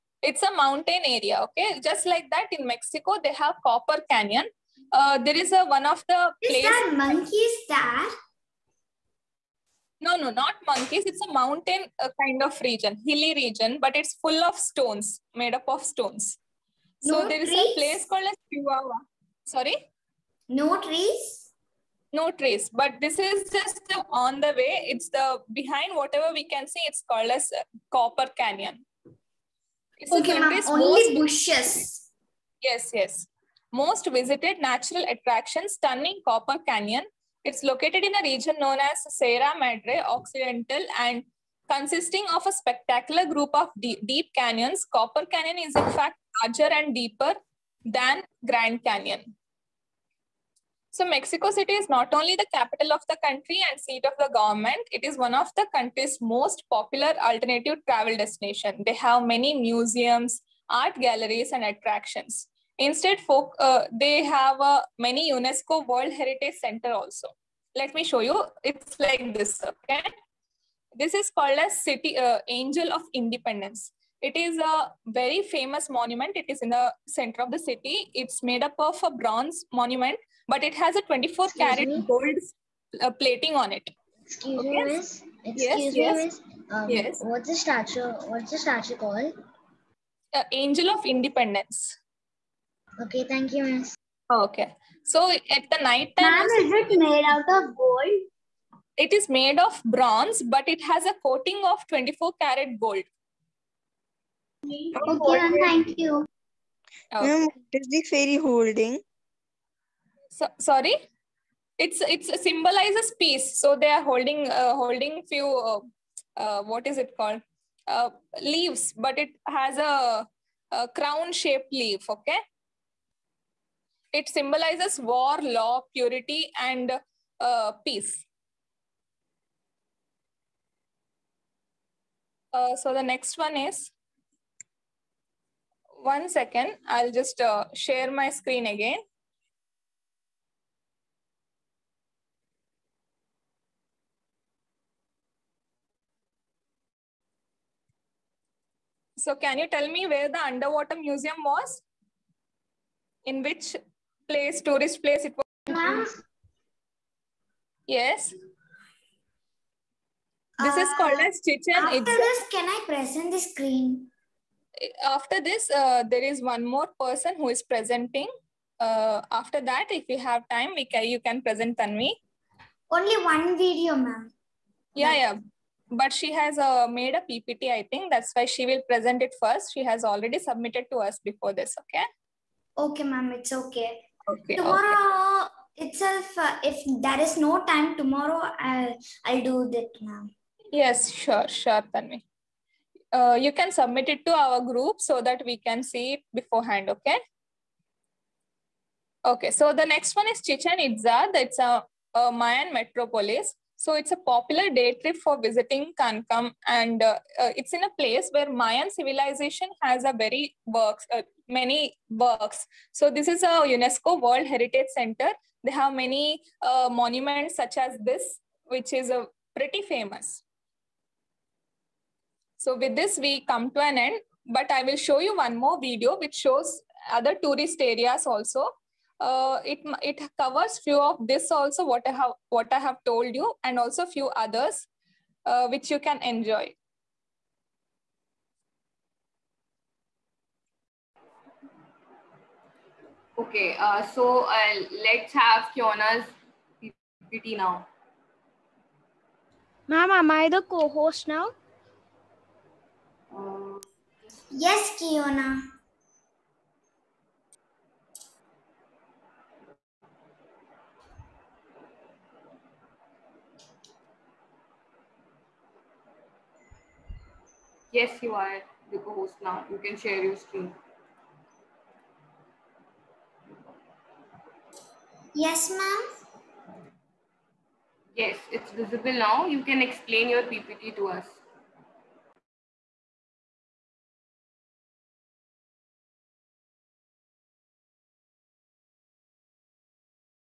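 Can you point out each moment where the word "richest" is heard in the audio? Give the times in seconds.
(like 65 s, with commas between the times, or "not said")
not said.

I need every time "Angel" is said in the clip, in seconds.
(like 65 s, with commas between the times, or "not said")
72 s, 90 s.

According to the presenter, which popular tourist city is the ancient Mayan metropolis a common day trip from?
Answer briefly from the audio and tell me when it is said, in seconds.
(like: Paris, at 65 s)
Cancun, at 205 s.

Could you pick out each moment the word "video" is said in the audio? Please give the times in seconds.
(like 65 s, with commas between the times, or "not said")
173 s, 225 s.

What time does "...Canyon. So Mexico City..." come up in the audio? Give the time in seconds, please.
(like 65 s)
48 s.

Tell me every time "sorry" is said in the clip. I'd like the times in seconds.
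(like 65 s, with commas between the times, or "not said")
19 s, 110 s.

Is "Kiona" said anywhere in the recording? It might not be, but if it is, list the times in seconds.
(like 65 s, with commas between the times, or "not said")
245 s, 255 s.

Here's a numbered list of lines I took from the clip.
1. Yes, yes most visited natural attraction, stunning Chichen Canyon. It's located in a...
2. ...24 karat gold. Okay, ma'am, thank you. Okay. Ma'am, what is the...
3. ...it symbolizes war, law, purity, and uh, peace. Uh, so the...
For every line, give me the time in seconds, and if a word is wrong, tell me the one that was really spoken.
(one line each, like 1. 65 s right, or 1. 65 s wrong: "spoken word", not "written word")
1. 32 s wrong: "Copper", not "Chichen"
2. 101 s right
3. 124 s right.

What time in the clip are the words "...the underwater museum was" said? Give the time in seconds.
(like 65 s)
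150 s.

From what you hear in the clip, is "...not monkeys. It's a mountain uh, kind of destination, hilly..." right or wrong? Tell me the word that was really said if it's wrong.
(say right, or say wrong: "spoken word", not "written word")
wrong: "region", not "destination".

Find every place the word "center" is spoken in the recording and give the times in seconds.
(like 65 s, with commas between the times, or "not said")
66 s, 77 s, 214 s.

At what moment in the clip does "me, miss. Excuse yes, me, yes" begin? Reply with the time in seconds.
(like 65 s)
84 s.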